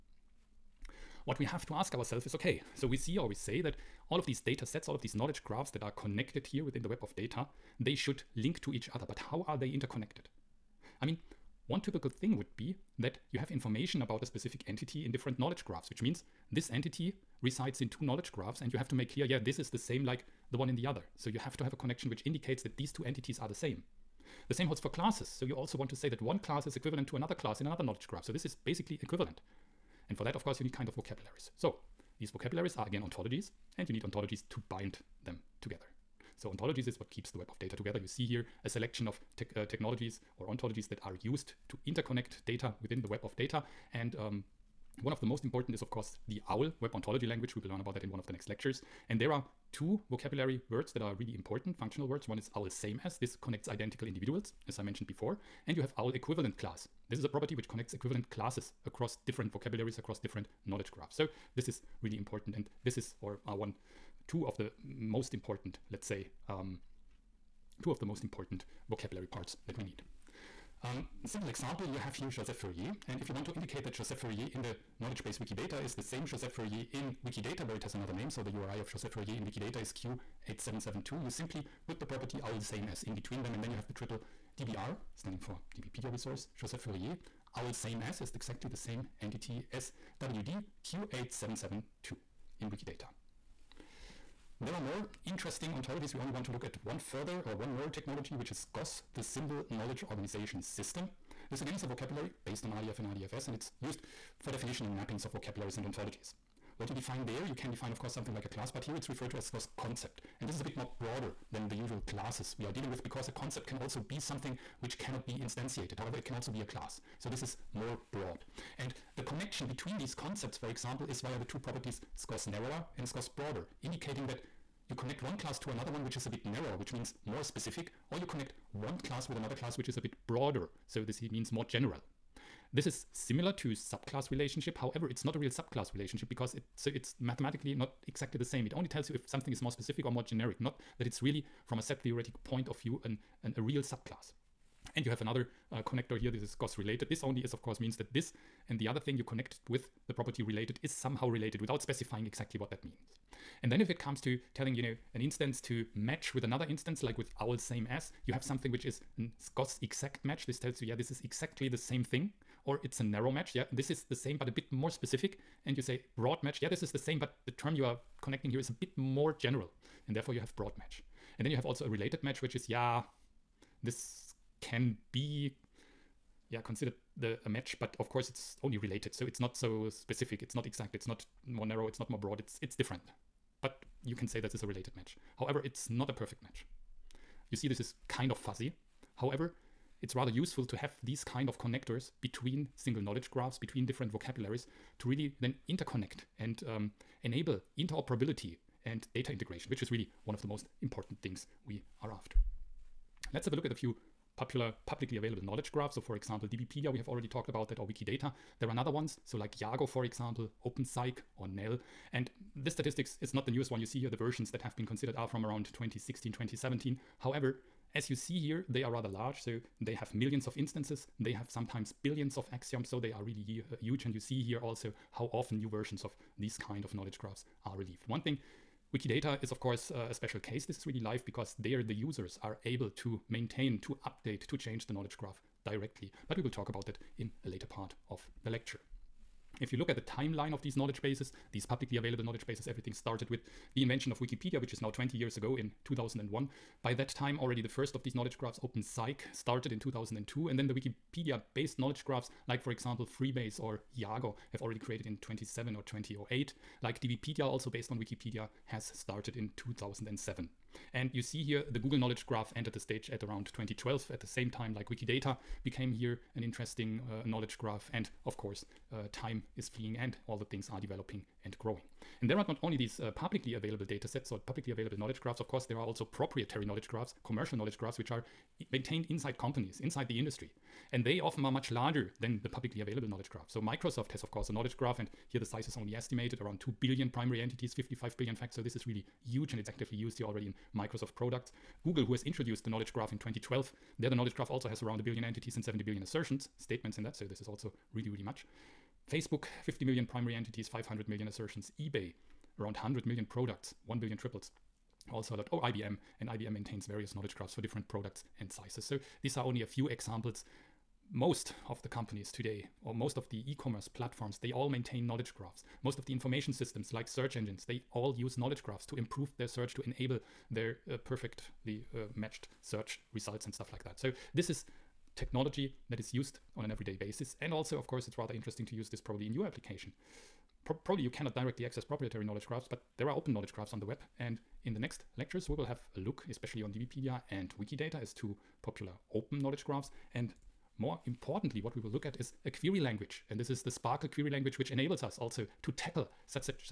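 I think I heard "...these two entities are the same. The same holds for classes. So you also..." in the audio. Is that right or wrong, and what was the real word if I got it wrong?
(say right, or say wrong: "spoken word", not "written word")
right.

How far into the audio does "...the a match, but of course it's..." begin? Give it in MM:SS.
02:57.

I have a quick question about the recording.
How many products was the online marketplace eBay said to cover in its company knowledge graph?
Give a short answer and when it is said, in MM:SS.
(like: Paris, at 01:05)
100 million, at 05:02.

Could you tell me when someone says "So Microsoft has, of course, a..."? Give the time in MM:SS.
04:43.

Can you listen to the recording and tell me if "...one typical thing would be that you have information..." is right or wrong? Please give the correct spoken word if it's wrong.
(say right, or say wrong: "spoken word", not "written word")
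right.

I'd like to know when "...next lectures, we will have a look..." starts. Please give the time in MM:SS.
05:34.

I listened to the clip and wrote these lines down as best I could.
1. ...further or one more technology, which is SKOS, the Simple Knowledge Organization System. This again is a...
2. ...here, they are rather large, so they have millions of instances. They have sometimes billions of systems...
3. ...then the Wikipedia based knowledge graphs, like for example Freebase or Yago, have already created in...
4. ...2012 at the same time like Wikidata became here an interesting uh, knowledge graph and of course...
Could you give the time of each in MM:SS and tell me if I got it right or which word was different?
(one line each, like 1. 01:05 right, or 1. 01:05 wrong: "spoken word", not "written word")
1. 01:36 right
2. 03:38 wrong: "axioms", not "systems"
3. 04:10 right
4. 04:23 right.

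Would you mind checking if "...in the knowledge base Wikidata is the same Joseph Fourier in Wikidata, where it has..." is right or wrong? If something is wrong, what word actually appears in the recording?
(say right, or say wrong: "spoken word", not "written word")
right.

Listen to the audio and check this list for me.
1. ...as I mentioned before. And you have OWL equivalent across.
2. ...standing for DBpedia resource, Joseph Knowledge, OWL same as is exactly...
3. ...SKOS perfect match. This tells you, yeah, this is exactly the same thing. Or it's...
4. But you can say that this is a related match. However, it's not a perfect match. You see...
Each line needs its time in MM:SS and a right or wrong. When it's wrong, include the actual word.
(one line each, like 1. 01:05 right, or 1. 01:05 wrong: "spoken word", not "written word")
1. 00:54 wrong: "class", not "across"
2. 01:25 wrong: "Fourier", not "Knowledge"
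3. 02:39 wrong: "exact", not "perfect"
4. 03:03 right.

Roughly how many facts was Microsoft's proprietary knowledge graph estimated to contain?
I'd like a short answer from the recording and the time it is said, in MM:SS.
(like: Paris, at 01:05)
55 billion, at 04:47.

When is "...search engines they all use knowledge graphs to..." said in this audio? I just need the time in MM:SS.
05:17.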